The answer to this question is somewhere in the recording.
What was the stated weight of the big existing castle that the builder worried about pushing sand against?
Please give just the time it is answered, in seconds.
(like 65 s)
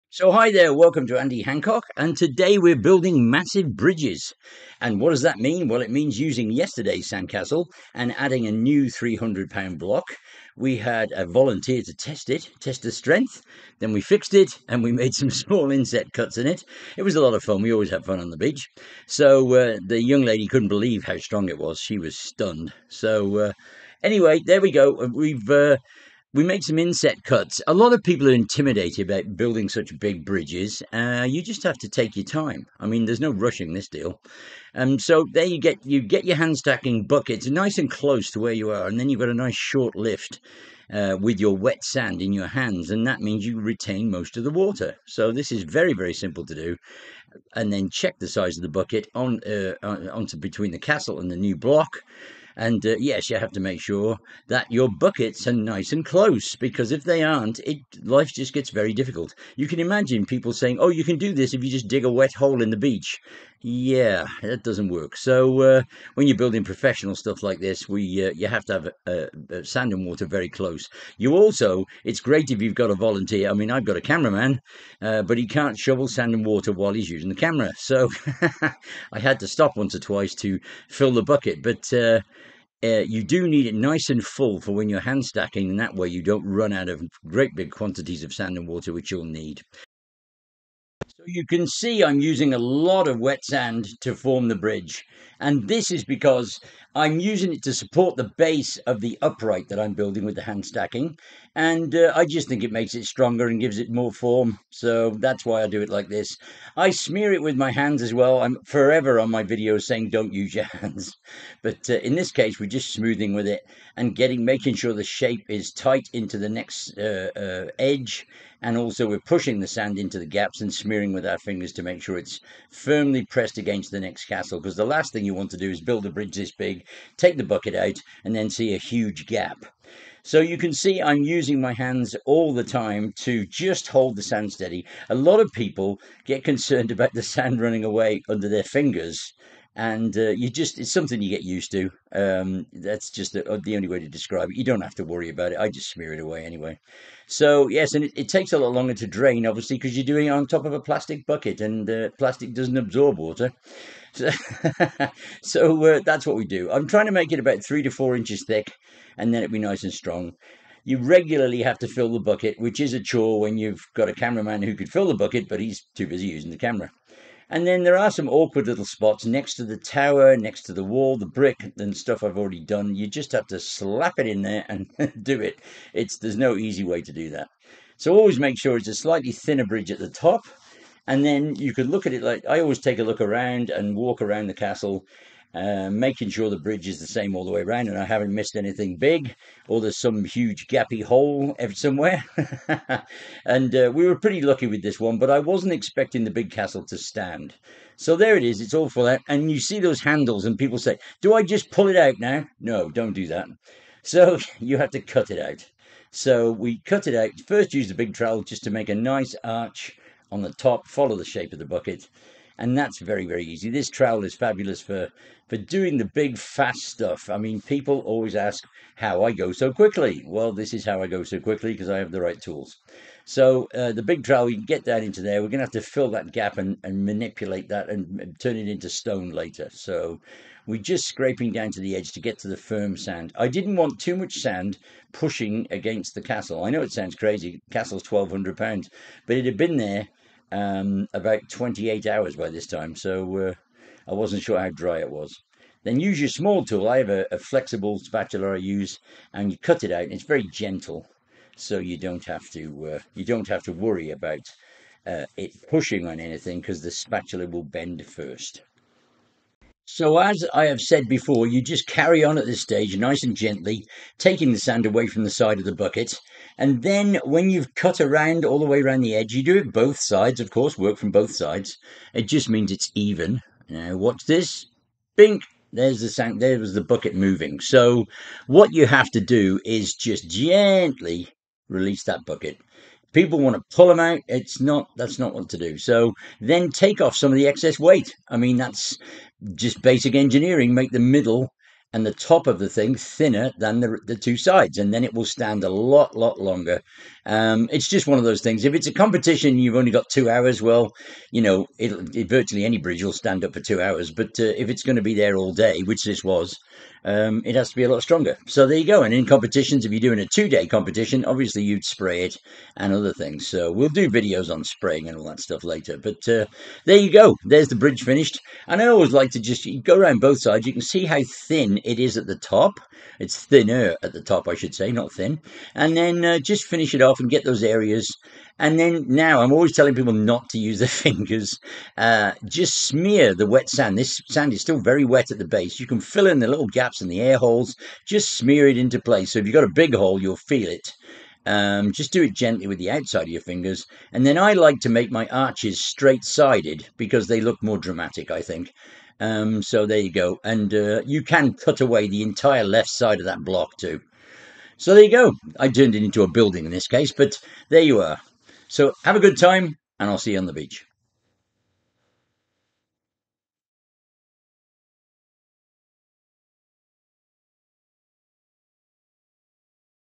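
238 s.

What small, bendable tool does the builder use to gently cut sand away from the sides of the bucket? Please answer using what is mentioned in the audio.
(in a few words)
flexible spatula.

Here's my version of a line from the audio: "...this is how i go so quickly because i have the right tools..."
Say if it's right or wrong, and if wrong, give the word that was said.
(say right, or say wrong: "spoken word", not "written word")
right.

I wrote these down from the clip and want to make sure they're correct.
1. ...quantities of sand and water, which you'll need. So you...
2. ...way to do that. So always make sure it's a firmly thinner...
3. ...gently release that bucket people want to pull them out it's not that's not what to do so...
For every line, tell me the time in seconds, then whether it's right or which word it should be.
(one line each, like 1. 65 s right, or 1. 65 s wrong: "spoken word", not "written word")
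1. 87 s right
2. 176 s wrong: "slightly", not "firmly"
3. 280 s right.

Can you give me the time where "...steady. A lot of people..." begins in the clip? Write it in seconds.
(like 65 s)
134 s.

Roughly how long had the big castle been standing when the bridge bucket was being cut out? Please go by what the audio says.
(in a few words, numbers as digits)
28 hours.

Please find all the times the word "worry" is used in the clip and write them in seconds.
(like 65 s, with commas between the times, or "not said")
145 s, 253 s.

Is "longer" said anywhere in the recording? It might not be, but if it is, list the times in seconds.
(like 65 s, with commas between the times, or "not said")
148 s, 296 s.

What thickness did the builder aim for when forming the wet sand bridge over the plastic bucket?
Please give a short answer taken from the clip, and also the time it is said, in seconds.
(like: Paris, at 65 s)
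3 to 4 inches, at 157 s.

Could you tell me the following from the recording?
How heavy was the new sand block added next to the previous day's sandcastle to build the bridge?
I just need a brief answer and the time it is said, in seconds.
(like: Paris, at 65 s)
300 pounds, at 8 s.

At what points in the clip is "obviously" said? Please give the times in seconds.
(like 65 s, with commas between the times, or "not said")
149 s, 311 s.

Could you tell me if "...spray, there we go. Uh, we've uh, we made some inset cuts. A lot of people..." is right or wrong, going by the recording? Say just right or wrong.
wrong.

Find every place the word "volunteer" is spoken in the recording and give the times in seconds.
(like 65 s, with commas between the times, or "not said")
11 s, 72 s.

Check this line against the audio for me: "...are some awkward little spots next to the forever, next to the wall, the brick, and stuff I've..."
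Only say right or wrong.
wrong.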